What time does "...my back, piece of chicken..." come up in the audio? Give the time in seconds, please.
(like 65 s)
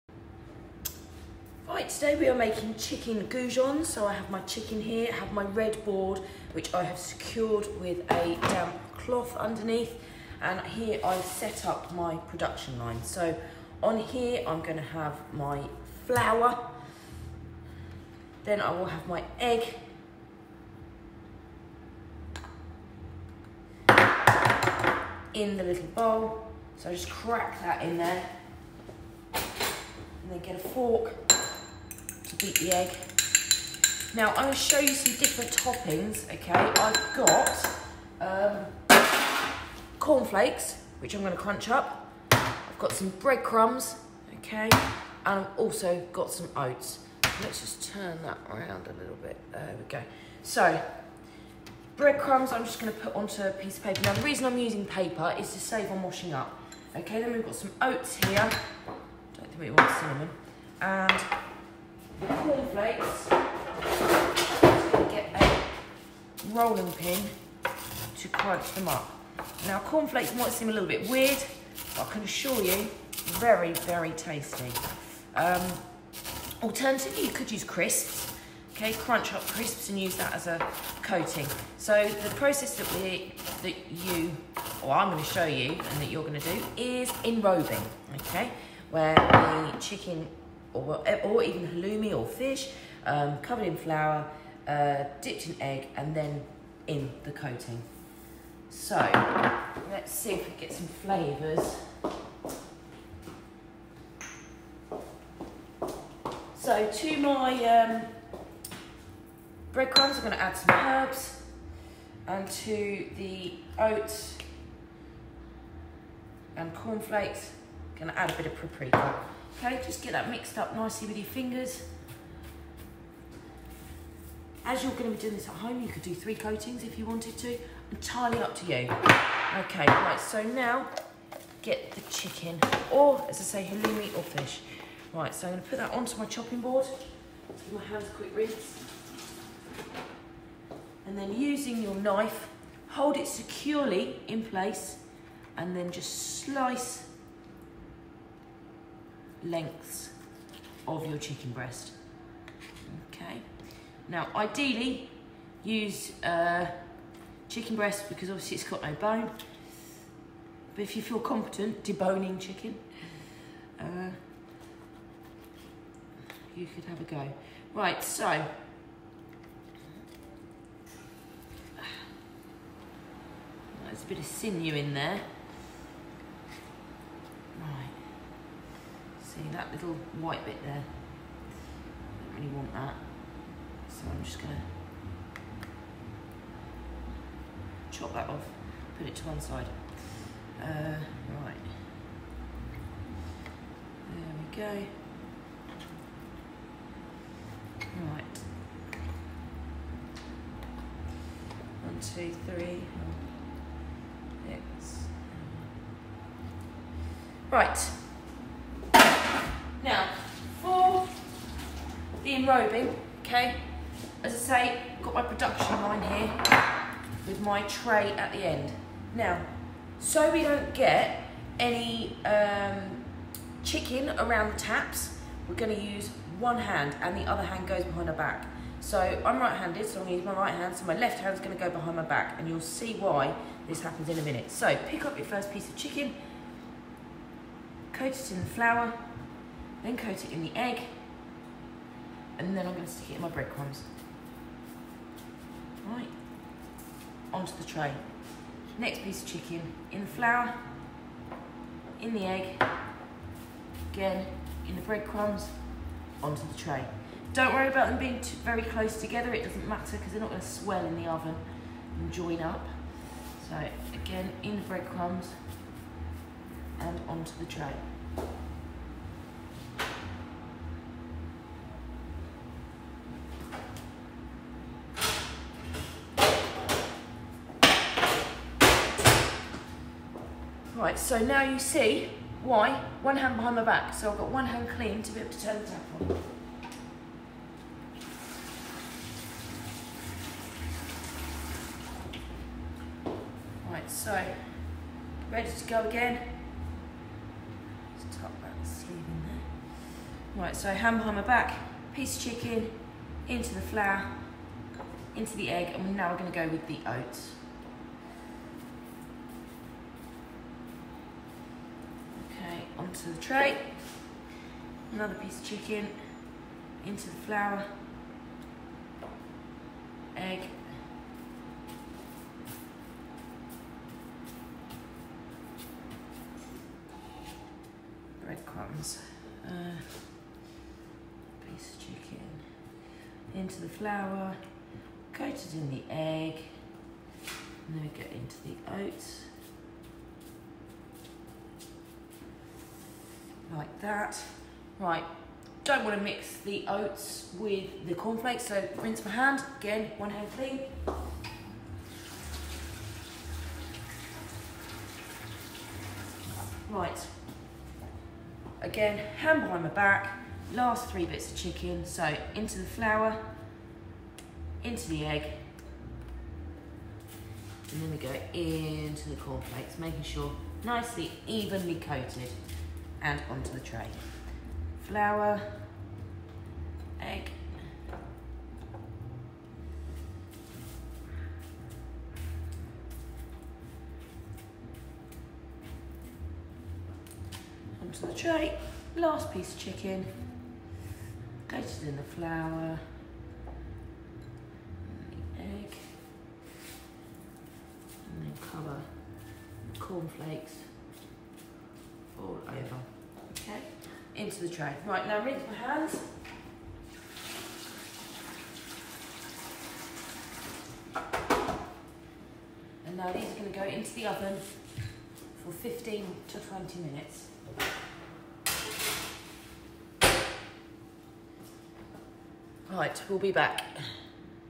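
301 s.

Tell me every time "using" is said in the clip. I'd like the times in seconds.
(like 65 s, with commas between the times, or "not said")
54 s, 141 s.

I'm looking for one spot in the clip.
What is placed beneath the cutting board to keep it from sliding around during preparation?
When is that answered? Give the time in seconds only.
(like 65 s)
8 s.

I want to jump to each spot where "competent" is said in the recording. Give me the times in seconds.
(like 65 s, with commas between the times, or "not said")
161 s.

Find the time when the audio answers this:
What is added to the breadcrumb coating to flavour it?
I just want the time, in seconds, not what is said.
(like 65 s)
110 s.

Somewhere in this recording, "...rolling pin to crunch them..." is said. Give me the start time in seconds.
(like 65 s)
66 s.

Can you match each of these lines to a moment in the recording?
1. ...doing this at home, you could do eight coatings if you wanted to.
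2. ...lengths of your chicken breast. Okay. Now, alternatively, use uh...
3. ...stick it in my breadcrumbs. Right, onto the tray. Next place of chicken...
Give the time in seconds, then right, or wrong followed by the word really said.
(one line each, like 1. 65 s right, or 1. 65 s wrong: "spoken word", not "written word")
1. 125 s wrong: "three", not "eight"
2. 149 s wrong: "ideally", not "alternatively"
3. 242 s wrong: "piece", not "place".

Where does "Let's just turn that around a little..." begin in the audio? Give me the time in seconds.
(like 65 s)
47 s.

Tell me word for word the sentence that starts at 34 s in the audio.
Now I'm going to show you some different toppings, okay?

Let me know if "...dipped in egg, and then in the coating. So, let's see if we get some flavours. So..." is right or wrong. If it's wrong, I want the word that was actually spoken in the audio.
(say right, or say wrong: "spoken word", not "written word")
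right.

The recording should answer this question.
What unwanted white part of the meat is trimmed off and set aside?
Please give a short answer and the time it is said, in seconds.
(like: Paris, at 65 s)
Sinew, at 174 s.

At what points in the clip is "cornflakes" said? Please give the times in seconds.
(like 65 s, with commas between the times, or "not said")
39 s, 62 s, 69 s, 116 s, 347 s, 369 s, 399 s.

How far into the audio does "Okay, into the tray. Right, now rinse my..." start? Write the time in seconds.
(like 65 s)
403 s.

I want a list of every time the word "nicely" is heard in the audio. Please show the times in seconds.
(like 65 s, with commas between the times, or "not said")
120 s, 370 s.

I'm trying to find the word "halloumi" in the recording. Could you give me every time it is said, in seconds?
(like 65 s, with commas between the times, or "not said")
91 s, 133 s.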